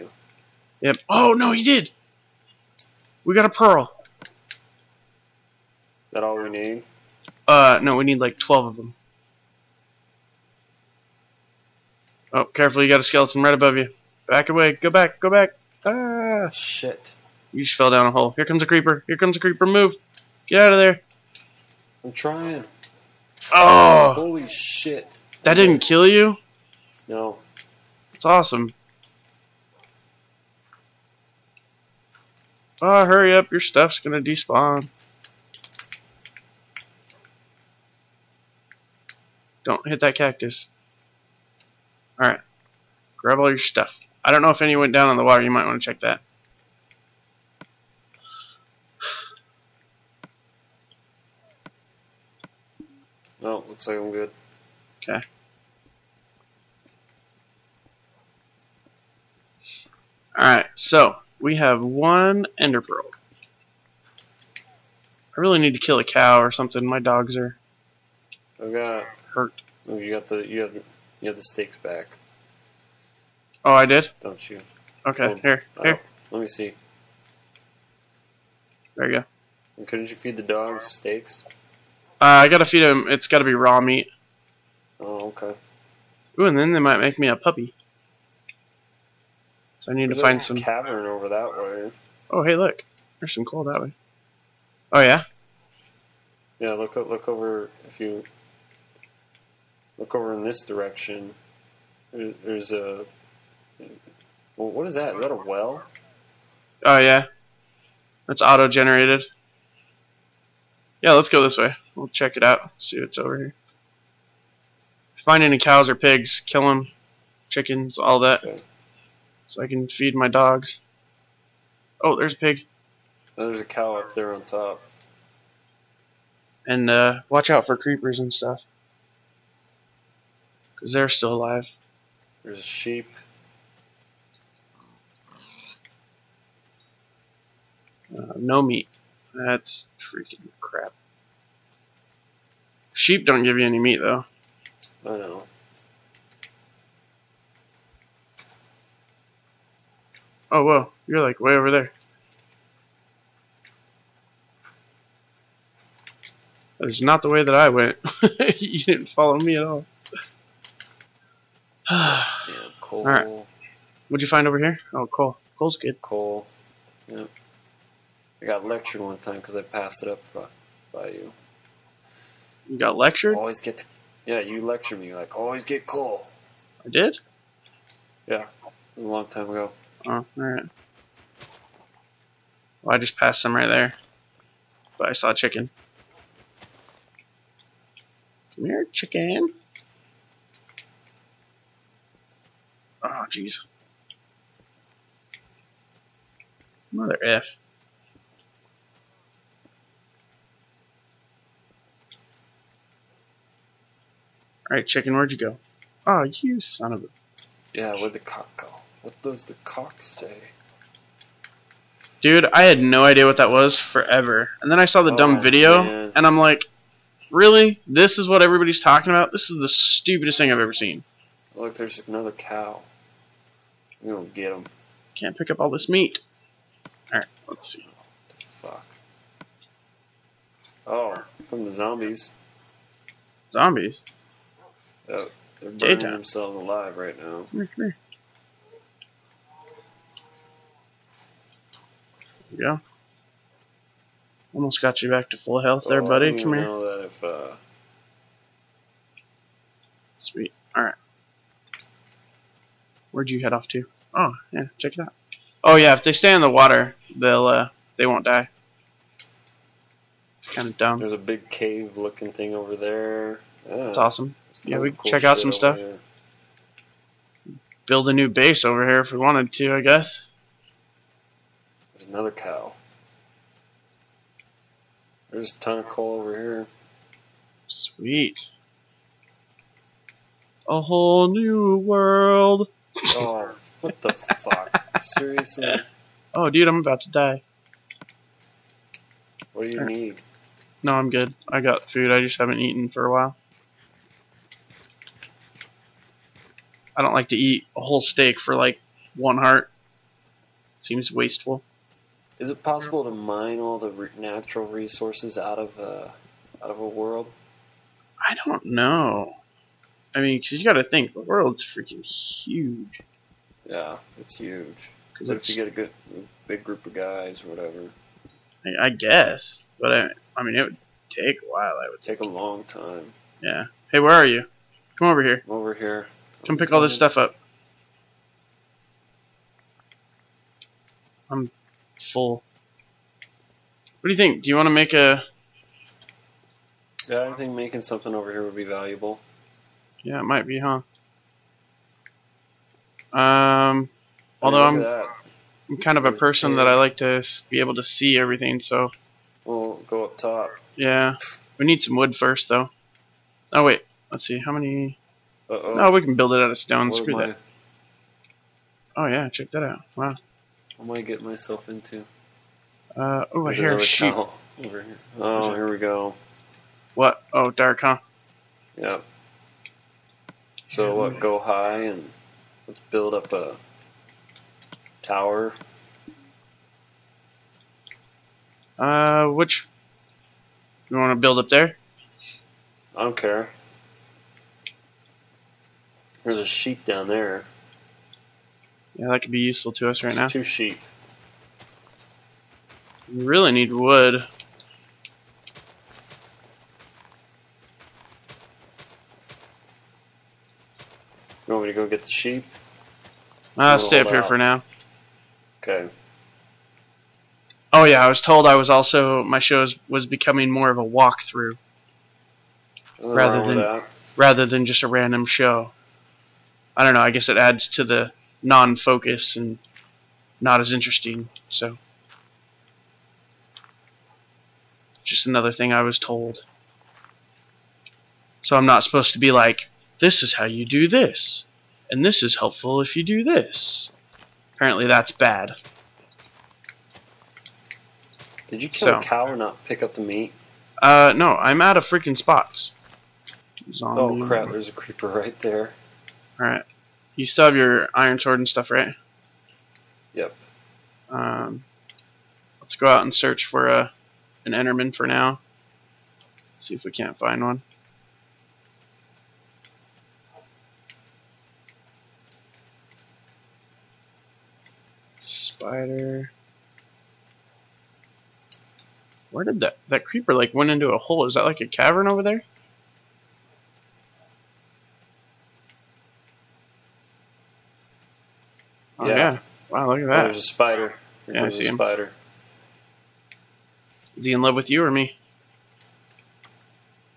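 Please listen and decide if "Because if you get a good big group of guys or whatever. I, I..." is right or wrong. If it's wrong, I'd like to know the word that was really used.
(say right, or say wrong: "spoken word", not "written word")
right.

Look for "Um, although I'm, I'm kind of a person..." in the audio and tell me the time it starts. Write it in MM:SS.
05:43.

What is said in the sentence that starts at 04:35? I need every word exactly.
There's a ton of coal over here.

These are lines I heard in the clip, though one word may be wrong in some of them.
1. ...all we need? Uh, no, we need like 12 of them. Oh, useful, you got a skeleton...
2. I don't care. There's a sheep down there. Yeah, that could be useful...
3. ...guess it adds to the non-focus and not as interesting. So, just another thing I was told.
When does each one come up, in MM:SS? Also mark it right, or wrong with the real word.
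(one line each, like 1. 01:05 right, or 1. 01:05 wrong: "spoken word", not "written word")
1. 00:06 wrong: "careful", not "useful"
2. 06:22 right
3. 06:57 right.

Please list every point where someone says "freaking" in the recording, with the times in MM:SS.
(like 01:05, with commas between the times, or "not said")
02:20, 05:11, 07:21.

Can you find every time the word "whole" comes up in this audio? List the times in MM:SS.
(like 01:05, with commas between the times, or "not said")
04:40, 04:57.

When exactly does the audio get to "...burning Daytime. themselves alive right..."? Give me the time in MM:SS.
03:55.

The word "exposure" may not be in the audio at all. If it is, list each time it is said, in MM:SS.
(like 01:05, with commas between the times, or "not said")
not said.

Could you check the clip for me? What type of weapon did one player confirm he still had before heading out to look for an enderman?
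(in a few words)
Iron sword.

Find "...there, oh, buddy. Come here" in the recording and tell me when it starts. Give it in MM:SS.
04:05.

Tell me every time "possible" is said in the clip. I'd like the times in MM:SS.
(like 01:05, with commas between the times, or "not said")
05:02.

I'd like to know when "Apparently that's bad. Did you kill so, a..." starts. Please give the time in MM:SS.
07:14.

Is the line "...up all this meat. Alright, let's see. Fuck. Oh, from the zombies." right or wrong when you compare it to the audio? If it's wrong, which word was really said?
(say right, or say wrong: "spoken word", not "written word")
right.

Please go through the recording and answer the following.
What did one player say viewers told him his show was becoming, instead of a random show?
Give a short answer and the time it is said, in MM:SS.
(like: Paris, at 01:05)
A walkthrough, at 06:50.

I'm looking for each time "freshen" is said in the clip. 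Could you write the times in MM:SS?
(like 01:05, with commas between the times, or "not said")
not said.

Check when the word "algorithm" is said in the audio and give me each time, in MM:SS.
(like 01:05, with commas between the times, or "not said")
not said.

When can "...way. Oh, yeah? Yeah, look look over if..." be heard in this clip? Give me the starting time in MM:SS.
01:33.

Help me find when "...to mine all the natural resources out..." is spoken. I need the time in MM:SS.
05:03.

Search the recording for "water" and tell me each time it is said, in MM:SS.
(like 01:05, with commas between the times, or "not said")
00:45, 04:16.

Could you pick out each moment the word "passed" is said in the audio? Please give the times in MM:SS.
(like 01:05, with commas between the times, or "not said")
02:49, 03:03.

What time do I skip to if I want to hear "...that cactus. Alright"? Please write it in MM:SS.
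00:39.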